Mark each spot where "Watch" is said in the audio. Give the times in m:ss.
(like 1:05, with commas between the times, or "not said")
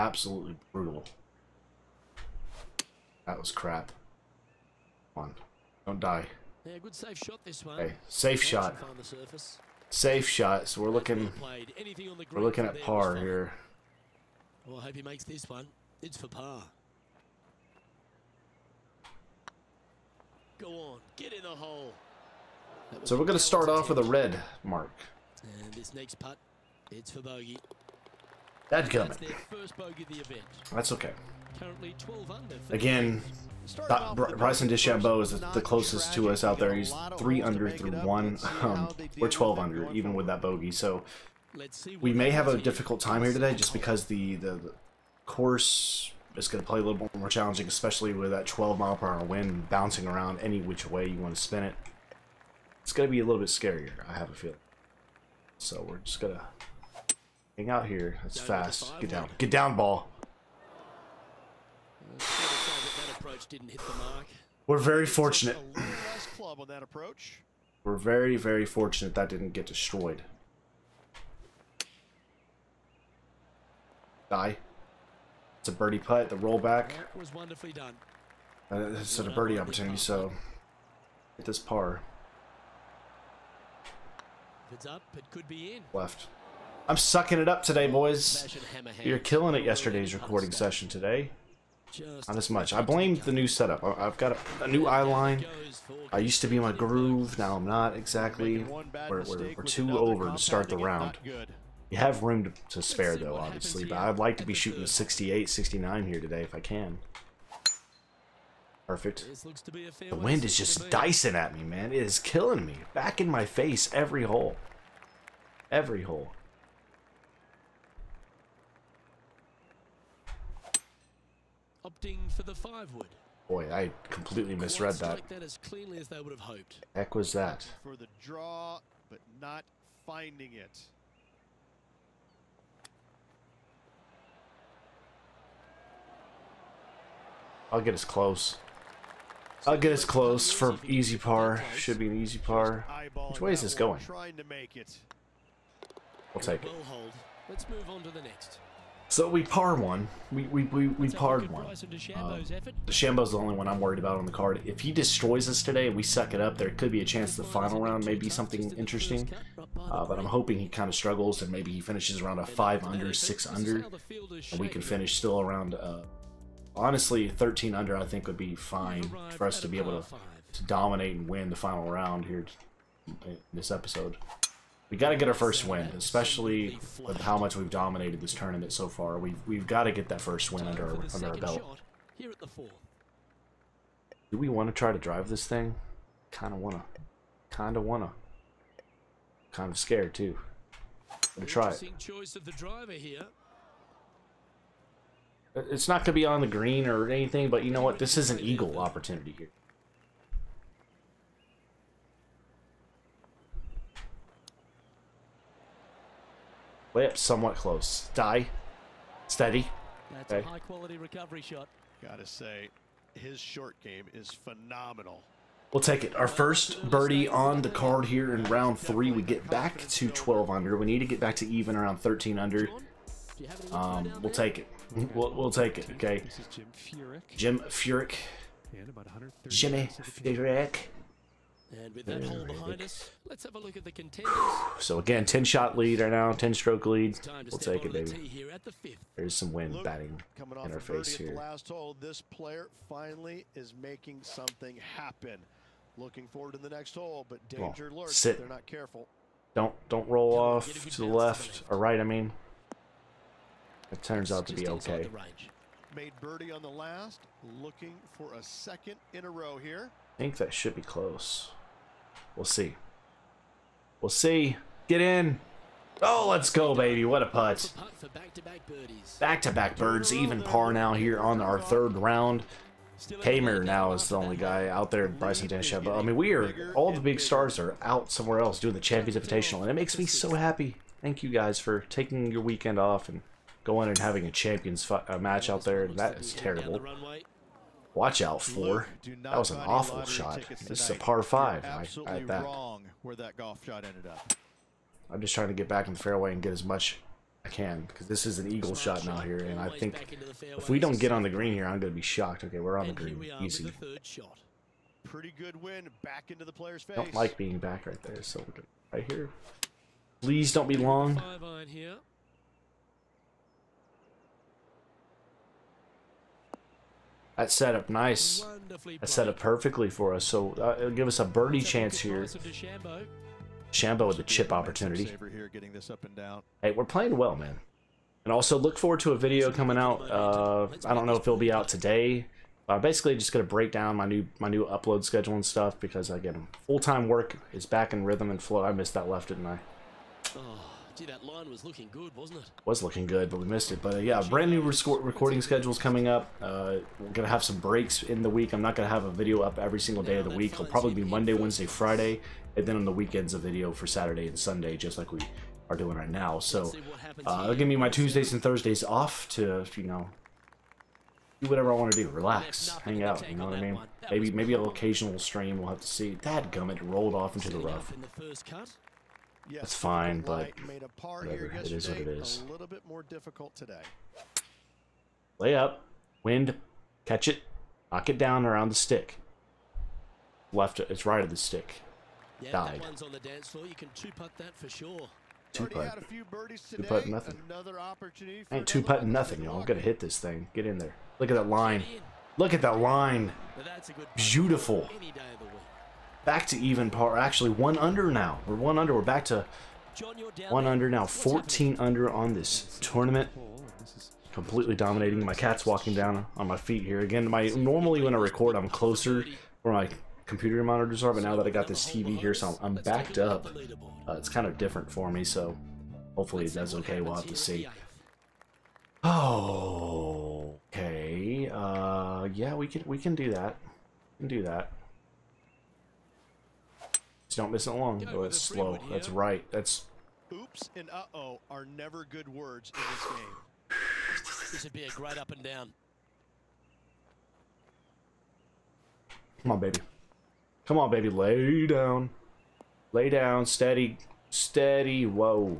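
4:47.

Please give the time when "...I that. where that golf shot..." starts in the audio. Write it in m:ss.
4:52.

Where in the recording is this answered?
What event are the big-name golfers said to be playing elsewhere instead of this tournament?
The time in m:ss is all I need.
4:38.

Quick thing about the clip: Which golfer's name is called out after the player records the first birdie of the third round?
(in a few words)
Jim Furyk.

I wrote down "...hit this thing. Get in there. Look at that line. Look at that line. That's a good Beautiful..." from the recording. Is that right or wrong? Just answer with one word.
right.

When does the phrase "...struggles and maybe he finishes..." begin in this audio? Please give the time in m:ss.
2:40.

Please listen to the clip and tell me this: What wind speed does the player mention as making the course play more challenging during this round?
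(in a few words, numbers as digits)
12 mile per hour.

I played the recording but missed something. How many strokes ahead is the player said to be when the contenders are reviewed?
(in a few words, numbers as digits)
10.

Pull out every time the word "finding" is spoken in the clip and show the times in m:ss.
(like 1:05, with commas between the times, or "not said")
2:10.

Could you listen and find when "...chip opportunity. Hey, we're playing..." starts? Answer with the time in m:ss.
5:24.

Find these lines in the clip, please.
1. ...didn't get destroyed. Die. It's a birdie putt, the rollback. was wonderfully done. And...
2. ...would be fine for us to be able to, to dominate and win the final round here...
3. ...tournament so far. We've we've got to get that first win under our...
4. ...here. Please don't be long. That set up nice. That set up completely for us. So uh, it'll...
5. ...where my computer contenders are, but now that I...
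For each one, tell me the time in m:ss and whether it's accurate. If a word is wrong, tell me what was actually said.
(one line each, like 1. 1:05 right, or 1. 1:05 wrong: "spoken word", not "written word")
1. 1:09 right
2. 2:48 right
3. 2:58 right
4. 5:09 wrong: "perfectly", not "completely"
5. 6:49 wrong: "monitors", not "contenders".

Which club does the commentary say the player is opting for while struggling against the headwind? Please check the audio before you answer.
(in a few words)
five wood.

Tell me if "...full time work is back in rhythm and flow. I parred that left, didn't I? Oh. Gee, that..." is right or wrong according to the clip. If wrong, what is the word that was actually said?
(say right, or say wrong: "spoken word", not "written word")
wrong: "missed", not "parred".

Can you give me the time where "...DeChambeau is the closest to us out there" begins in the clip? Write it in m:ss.
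0:34.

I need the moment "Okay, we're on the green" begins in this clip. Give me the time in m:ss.
5:02.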